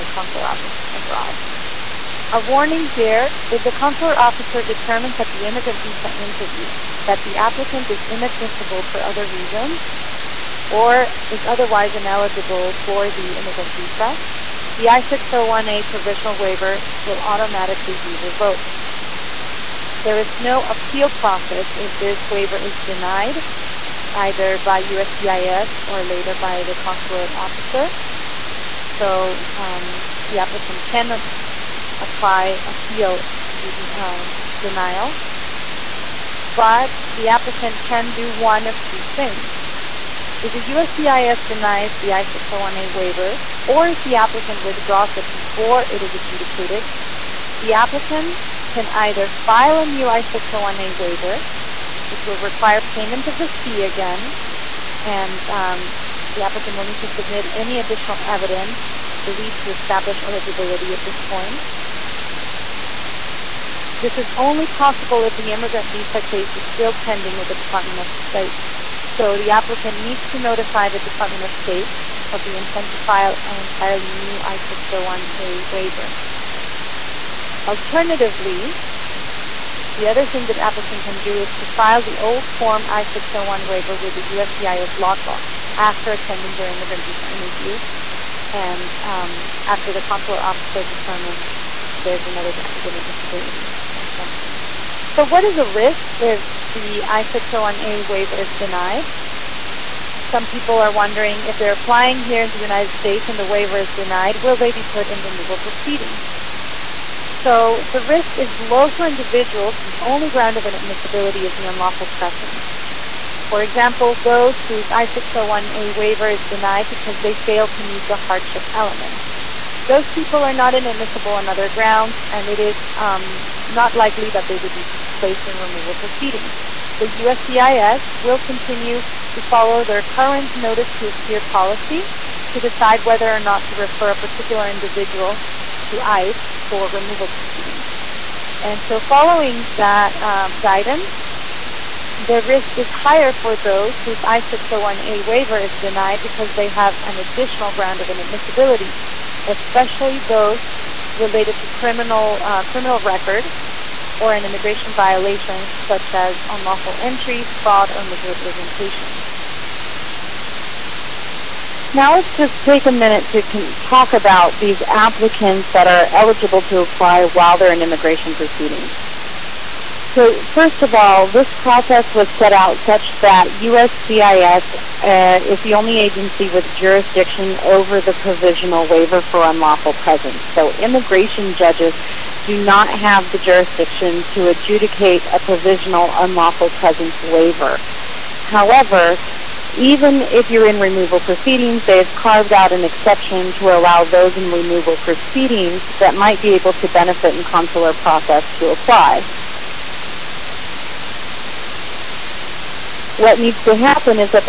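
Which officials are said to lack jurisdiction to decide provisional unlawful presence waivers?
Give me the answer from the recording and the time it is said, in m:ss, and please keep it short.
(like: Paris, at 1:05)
Immigration judges, at 3:00.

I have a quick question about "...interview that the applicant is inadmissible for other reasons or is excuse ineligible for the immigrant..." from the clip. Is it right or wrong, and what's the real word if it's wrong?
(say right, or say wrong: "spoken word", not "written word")
wrong: "otherwise", not "excuse".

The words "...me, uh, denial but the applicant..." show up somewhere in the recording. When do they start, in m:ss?
0:33.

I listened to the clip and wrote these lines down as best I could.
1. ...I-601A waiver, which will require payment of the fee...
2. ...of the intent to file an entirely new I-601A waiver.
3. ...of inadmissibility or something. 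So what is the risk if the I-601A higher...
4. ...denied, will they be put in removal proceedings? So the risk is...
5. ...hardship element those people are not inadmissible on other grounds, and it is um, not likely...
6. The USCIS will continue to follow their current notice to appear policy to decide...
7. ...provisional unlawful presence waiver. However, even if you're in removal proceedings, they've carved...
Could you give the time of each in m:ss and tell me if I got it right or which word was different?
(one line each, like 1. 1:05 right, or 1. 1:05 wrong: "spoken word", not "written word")
1. 0:50 right
2. 1:12 right
3. 1:32 wrong: "waiver", not "higher"
4. 1:43 right
5. 1:58 right
6. 2:06 right
7. 3:05 right.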